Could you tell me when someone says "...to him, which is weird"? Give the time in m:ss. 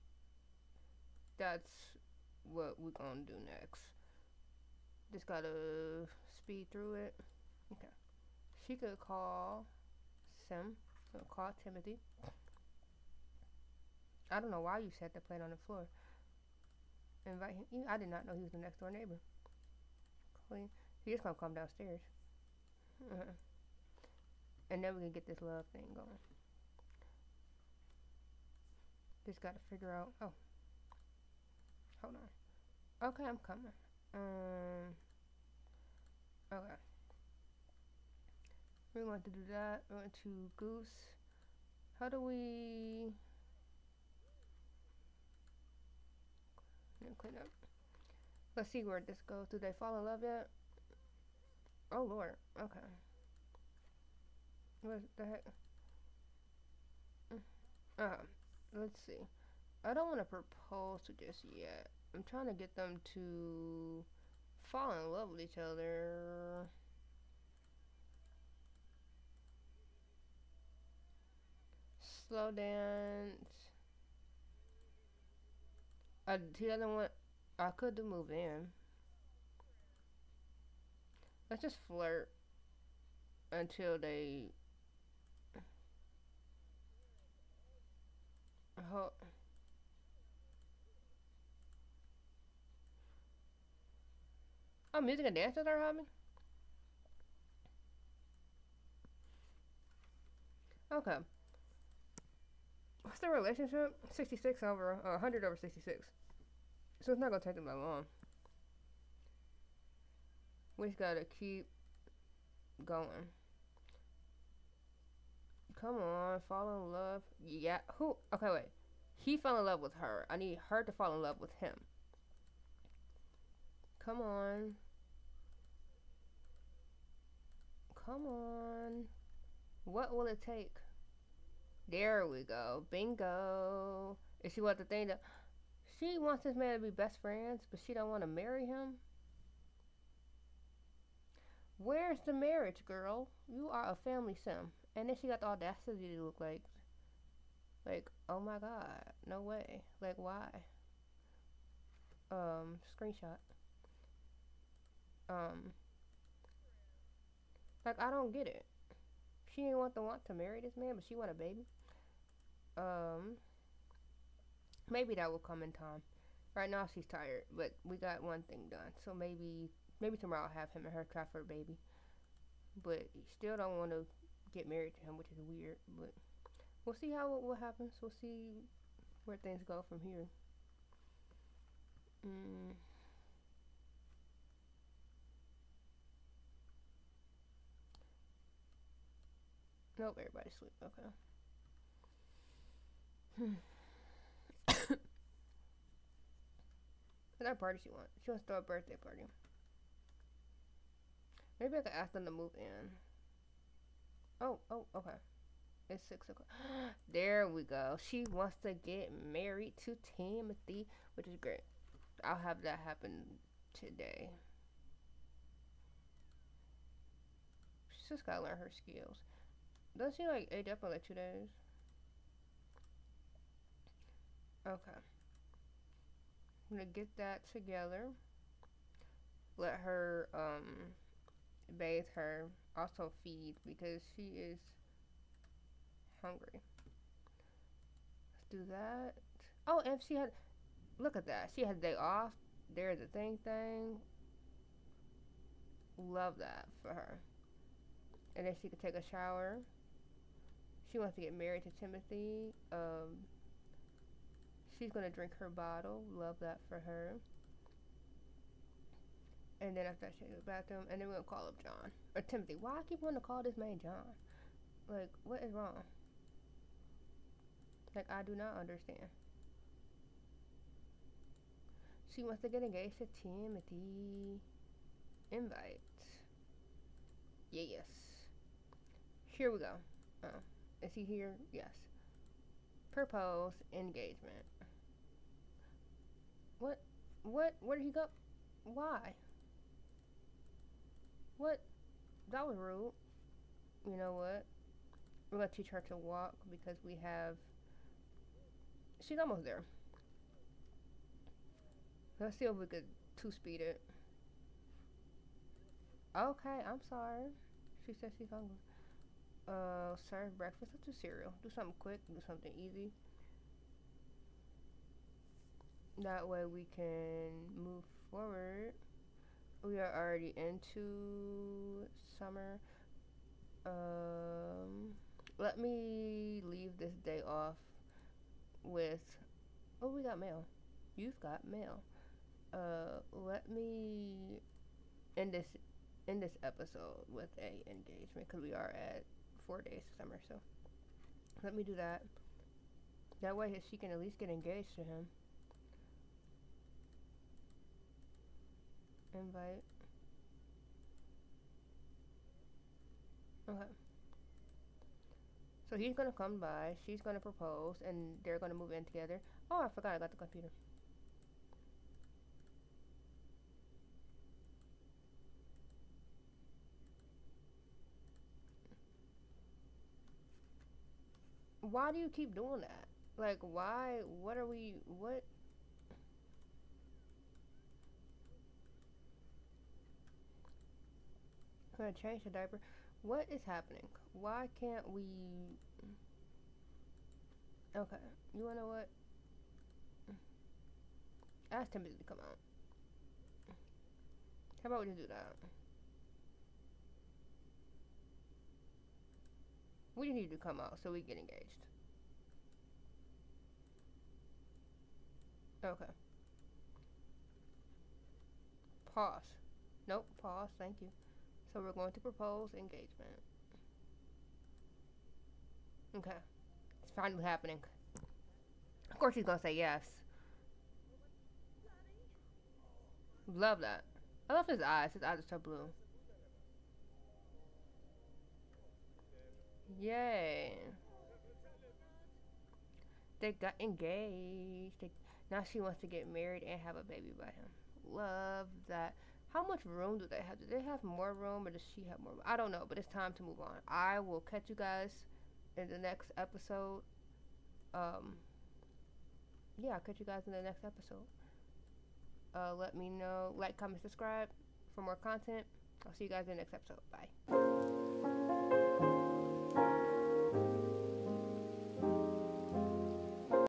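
2:55.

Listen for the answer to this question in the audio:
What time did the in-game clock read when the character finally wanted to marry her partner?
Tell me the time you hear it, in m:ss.
3:26.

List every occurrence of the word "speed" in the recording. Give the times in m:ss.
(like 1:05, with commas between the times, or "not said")
0:06, 5:03.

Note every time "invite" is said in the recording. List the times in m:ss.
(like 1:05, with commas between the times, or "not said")
0:17, 4:35, 5:49.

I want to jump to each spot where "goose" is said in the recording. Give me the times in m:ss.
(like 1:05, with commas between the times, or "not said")
0:40.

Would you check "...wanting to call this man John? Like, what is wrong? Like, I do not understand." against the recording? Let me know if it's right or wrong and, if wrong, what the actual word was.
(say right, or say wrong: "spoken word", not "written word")
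right.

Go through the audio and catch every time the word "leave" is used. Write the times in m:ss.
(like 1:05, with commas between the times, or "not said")
5:26.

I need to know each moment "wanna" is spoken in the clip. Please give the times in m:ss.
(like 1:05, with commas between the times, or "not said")
6:28.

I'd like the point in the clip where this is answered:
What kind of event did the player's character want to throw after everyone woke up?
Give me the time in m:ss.
3:18.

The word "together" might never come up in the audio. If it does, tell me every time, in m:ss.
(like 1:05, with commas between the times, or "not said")
3:47, 5:58.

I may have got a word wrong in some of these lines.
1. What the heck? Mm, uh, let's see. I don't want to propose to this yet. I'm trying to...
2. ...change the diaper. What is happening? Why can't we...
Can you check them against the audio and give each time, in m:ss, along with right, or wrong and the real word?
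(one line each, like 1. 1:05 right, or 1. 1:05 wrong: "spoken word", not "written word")
1. 0:54 right
2. 6:22 right.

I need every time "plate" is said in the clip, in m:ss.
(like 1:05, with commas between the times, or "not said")
0:15.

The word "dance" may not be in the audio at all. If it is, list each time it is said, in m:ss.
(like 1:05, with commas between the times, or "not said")
1:12, 1:35.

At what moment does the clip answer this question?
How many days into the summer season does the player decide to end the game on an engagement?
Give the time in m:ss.
5:39.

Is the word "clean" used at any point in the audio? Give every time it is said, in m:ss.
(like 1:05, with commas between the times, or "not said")
0:20, 0:47.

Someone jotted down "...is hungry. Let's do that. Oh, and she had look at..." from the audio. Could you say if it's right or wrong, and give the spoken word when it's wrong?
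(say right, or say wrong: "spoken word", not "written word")
right.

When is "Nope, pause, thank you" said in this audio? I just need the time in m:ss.
6:49.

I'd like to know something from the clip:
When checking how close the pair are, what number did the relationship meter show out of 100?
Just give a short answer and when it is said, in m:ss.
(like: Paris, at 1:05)
66, at 1:45.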